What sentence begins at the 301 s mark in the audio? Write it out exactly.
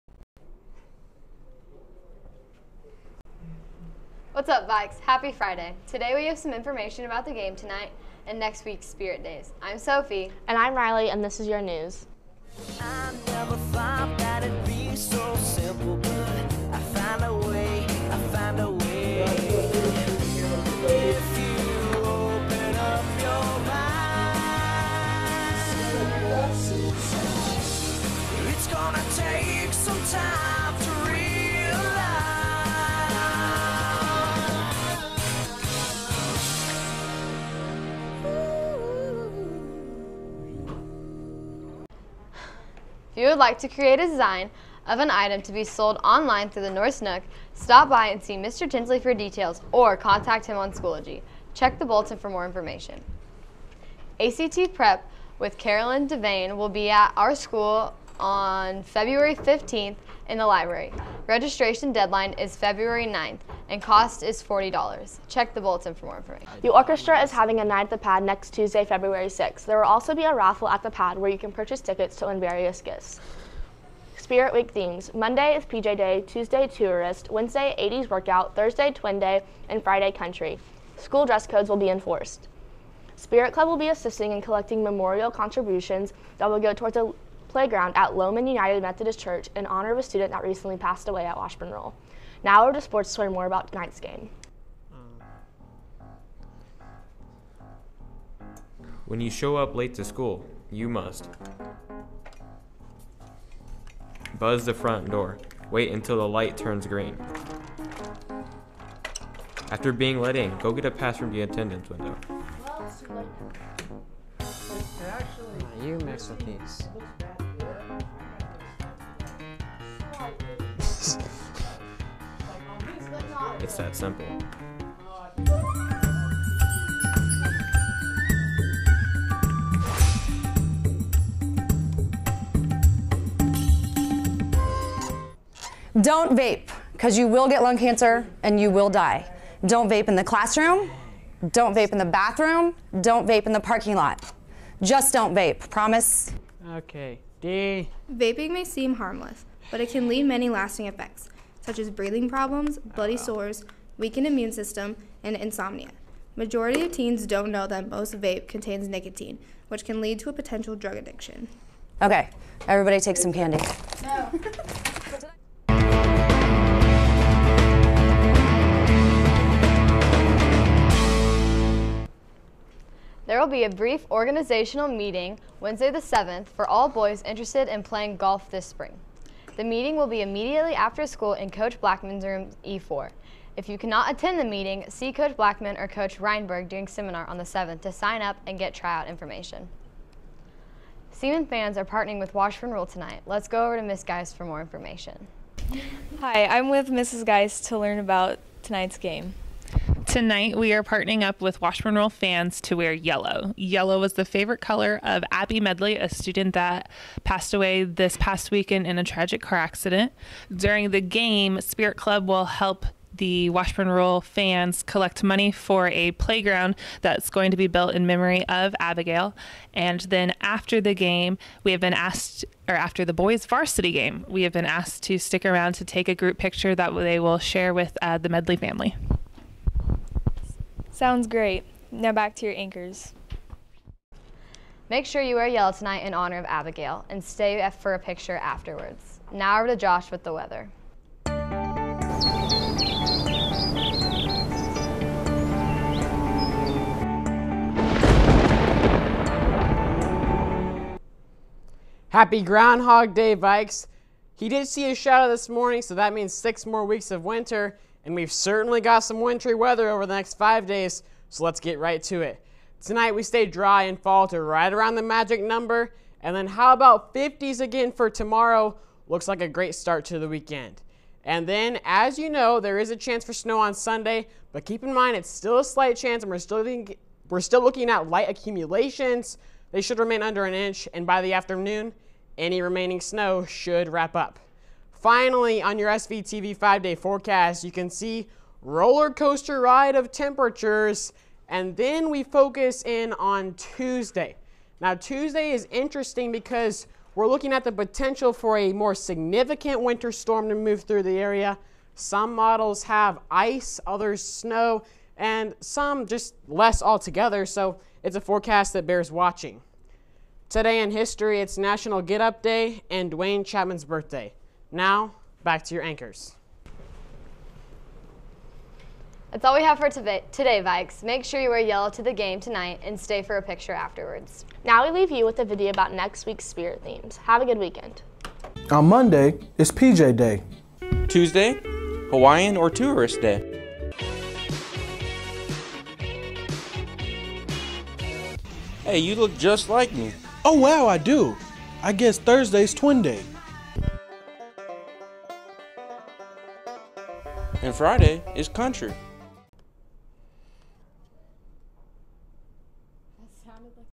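Some models have ice, others snow, and some just less altogether.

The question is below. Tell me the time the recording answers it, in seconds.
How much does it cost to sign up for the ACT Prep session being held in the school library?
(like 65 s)
64 s.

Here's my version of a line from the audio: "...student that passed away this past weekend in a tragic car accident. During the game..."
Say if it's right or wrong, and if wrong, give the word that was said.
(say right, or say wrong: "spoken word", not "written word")
right.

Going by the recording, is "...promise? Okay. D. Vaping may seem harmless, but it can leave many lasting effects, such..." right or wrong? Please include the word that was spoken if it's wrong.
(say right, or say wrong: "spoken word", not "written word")
right.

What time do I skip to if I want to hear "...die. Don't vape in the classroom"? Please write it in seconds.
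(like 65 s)
138 s.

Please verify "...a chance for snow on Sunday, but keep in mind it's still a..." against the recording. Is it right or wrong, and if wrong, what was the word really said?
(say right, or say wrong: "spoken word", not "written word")
right.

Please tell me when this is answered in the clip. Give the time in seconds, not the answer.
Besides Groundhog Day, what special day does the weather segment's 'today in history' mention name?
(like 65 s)
311 s.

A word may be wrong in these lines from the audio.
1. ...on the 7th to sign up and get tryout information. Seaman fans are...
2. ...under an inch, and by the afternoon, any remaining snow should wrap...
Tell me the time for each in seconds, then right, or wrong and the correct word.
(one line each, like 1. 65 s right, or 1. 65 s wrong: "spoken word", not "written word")
1. 187 s right
2. 280 s right.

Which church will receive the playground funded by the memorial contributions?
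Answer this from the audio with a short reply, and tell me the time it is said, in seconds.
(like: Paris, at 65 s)
Lowman United Methodist Church, at 88 s.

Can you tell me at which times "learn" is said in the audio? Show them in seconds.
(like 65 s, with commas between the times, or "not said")
93 s, 197 s.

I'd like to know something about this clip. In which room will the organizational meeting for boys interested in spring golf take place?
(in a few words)
E4.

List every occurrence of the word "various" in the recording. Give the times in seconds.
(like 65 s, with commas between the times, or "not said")
72 s.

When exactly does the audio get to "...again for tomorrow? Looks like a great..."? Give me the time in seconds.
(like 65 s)
267 s.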